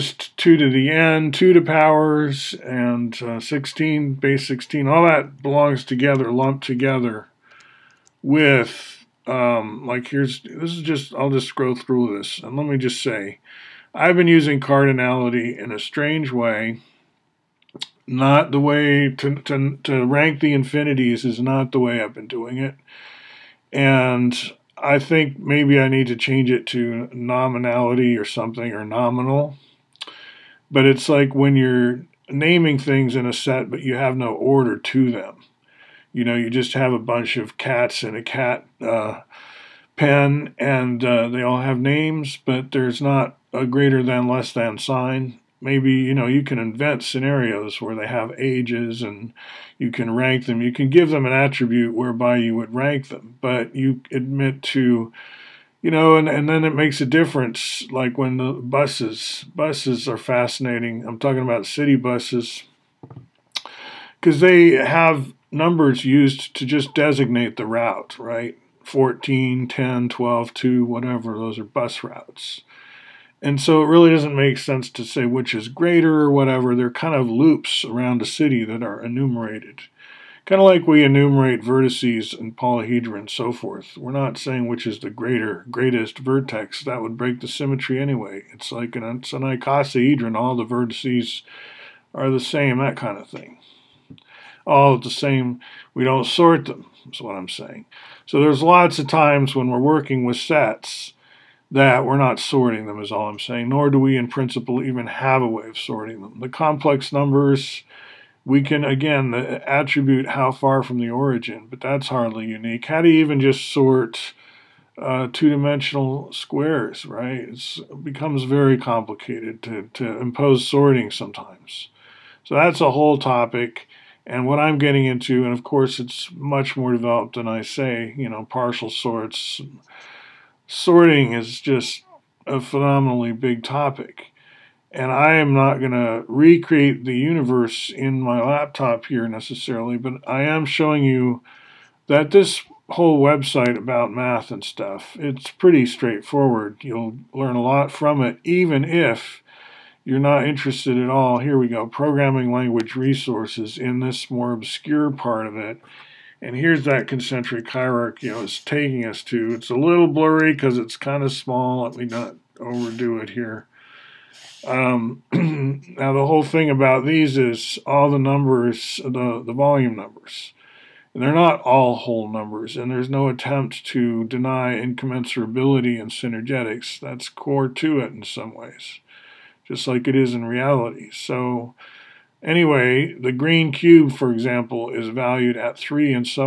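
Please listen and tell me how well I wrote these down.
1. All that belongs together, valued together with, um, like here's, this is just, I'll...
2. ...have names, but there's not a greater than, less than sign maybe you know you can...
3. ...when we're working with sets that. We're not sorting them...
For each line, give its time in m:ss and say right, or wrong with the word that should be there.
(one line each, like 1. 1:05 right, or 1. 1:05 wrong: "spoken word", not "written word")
1. 0:04 wrong: "lumped", not "valued"
2. 0:41 right
3. 1:39 right.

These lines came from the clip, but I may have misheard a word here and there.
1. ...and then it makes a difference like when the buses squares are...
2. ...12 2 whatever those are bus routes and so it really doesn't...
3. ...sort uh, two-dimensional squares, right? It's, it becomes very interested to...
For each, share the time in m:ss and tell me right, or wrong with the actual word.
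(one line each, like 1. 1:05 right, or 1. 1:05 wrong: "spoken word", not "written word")
1. 0:56 wrong: "buses", not "squares"
2. 1:10 right
3. 1:53 wrong: "complicated", not "interested".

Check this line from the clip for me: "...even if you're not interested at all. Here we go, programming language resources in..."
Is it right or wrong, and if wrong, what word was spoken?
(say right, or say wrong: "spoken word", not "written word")
right.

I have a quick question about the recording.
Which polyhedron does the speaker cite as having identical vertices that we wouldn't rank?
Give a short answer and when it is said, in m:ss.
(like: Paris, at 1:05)
icosahedron, at 1:29.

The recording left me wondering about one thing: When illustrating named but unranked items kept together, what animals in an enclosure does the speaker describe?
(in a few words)
cats.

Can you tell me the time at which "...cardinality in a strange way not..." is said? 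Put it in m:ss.
0:14.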